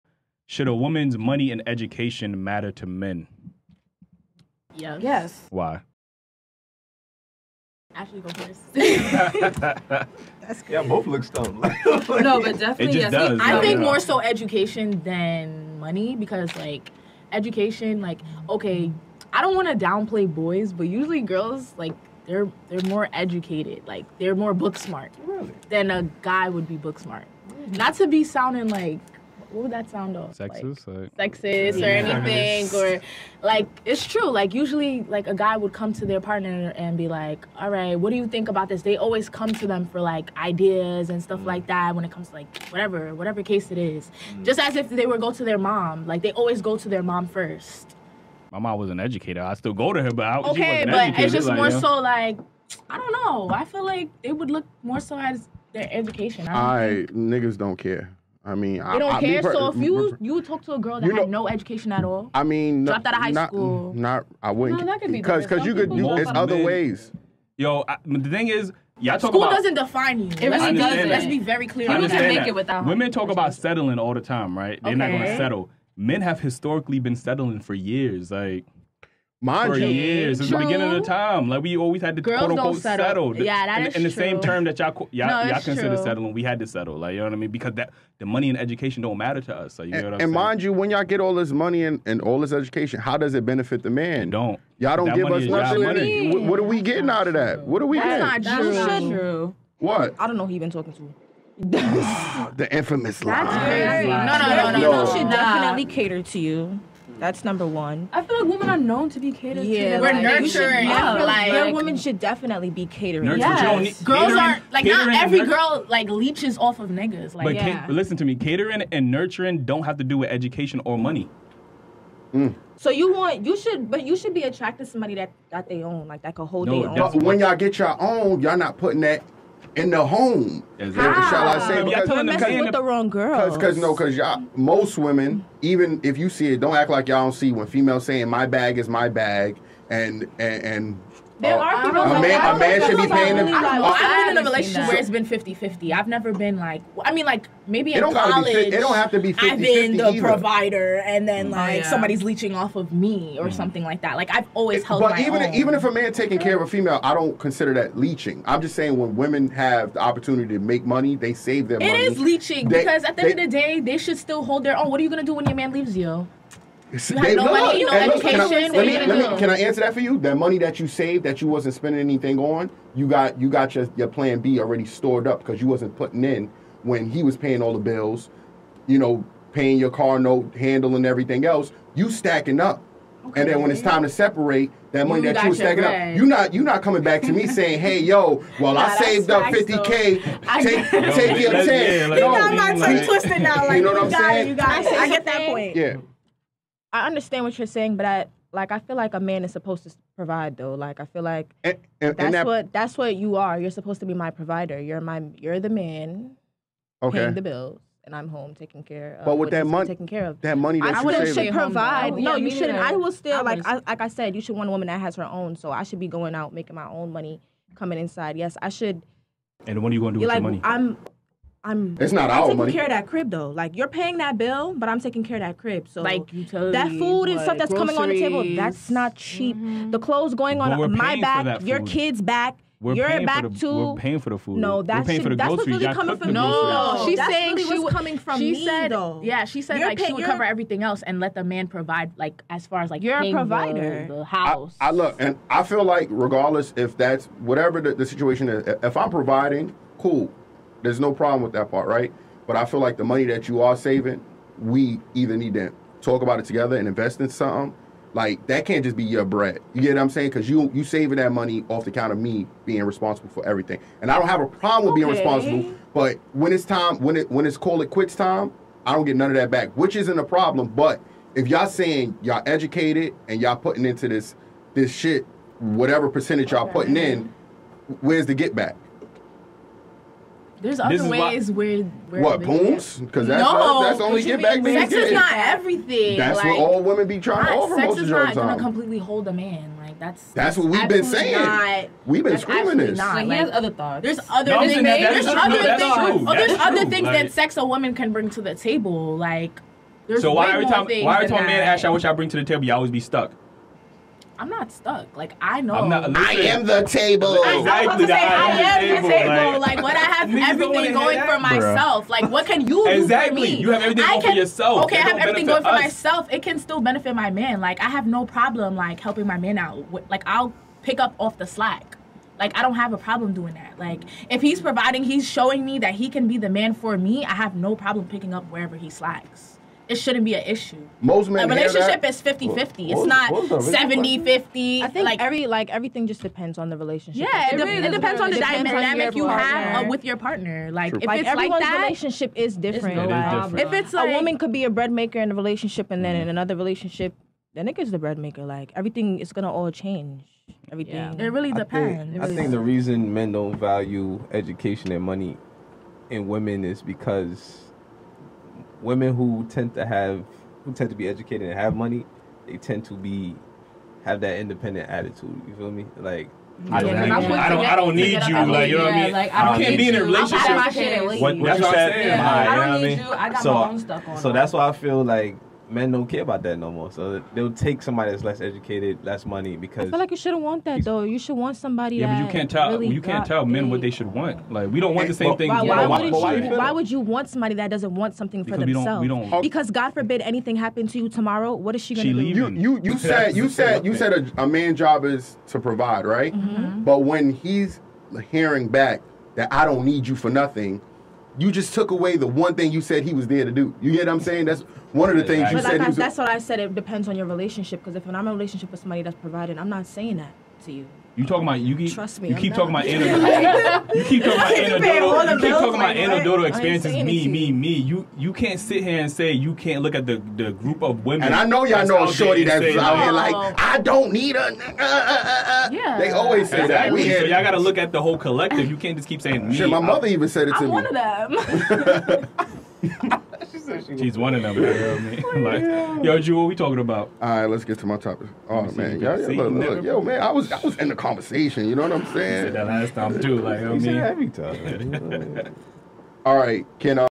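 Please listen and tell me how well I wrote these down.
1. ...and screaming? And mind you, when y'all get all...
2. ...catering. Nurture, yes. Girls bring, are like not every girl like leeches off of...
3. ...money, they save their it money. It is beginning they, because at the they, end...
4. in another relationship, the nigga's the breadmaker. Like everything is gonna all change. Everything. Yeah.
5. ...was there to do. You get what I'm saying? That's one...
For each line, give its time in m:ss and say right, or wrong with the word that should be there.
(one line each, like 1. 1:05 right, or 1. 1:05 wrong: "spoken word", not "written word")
1. 1:30 wrong: "saying", not "screaming"
2. 1:52 wrong: "catering", not "bring"
3. 2:40 wrong: "leeching", not "beginning"
4. 5:46 right
5. 6:43 right.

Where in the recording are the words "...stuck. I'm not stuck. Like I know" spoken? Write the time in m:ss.
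5:02.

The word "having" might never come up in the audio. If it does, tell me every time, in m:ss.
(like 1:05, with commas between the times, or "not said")
not said.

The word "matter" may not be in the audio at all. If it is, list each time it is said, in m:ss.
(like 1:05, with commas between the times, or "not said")
0:02, 1:29.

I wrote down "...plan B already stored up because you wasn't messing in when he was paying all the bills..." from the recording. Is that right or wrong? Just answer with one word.
wrong.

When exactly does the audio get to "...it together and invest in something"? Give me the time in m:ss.
4:16.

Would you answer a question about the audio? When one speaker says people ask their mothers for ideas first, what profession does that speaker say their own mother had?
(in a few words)
educator.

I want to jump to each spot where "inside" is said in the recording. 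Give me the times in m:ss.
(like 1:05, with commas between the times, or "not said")
3:37.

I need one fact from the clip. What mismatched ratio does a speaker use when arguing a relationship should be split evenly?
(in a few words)
70-50.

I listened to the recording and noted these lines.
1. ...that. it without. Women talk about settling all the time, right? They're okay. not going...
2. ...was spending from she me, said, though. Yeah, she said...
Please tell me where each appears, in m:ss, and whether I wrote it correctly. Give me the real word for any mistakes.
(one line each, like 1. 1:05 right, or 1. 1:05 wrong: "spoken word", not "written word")
1. 1:12 right
2. 3:57 wrong: "coming", not "spending".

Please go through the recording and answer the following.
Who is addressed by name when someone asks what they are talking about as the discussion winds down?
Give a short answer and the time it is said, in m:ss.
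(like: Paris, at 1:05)
Drew, at 7:16.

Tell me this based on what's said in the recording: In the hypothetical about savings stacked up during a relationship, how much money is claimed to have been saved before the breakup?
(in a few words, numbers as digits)
50k.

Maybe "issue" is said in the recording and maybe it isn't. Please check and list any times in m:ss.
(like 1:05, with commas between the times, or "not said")
5:30.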